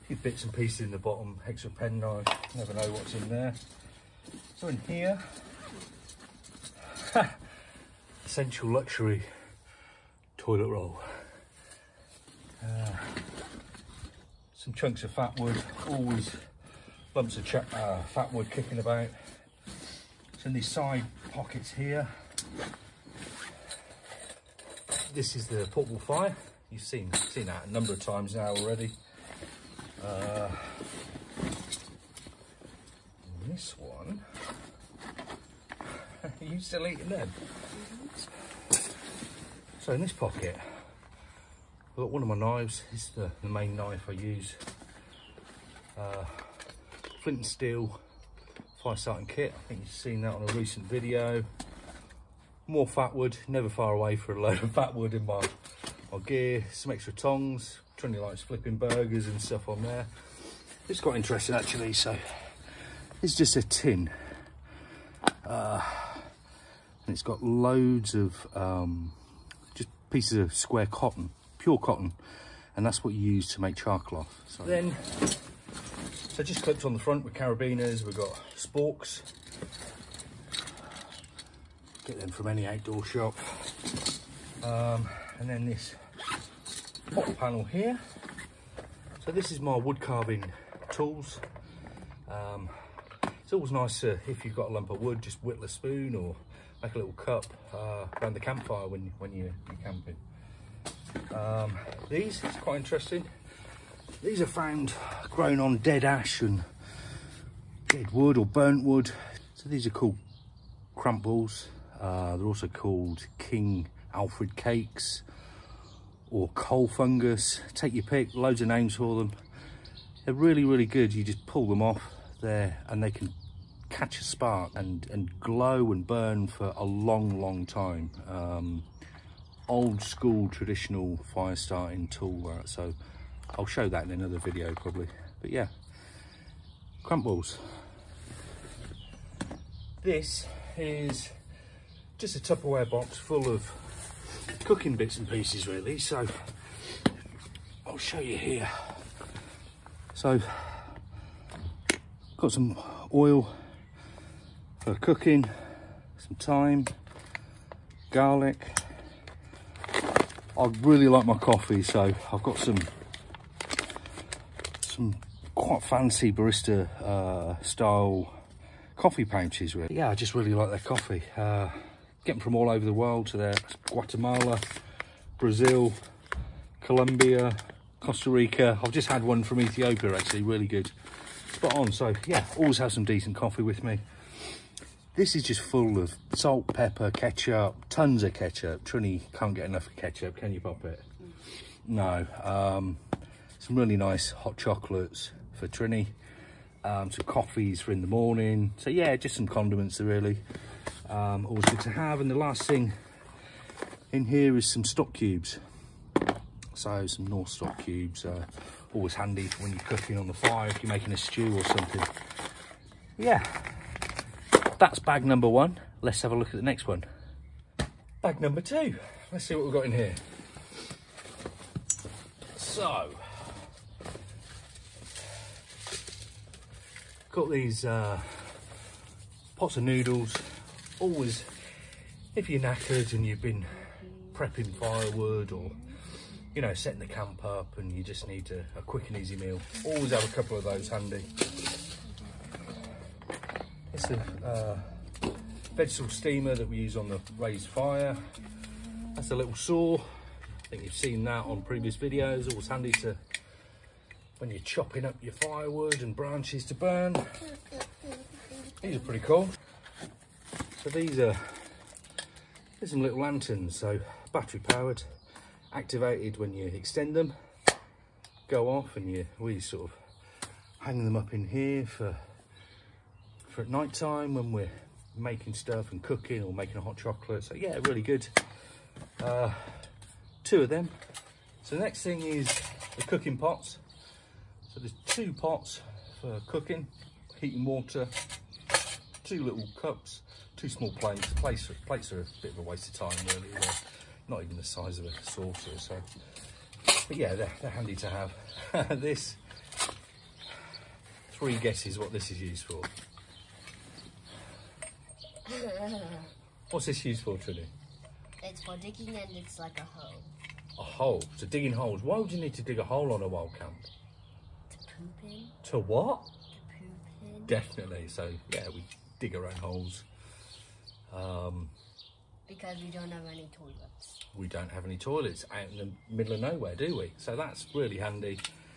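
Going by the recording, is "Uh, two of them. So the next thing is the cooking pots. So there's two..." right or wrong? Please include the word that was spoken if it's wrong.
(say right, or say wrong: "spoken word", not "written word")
right.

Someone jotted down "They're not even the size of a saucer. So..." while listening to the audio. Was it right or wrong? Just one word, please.
right.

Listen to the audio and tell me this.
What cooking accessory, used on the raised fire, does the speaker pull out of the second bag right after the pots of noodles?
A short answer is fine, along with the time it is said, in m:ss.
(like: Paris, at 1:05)
Vegetable steamer, at 4:05.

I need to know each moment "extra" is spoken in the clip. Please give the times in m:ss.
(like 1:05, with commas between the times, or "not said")
0:01, 0:56.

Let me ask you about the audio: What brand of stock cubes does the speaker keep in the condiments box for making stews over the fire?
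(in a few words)
Knorr.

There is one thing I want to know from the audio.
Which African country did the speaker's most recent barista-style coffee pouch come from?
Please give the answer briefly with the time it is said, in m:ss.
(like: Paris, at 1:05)
Ethiopia, at 2:59.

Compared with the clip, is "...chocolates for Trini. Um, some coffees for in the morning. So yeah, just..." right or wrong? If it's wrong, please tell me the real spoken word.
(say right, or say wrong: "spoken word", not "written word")
right.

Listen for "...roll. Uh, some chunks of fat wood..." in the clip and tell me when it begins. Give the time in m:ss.
0:10.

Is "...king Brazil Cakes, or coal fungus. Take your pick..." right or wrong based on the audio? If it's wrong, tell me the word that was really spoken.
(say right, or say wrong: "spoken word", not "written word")
wrong: "Alfred", not "Brazil".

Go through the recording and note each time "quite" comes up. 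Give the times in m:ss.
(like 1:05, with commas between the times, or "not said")
1:01, 1:42, 2:45.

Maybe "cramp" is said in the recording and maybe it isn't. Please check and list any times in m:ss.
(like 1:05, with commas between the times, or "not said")
1:50, 2:17.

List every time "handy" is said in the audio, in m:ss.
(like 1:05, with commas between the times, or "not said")
3:29, 4:00, 4:12, 4:57, 5:27.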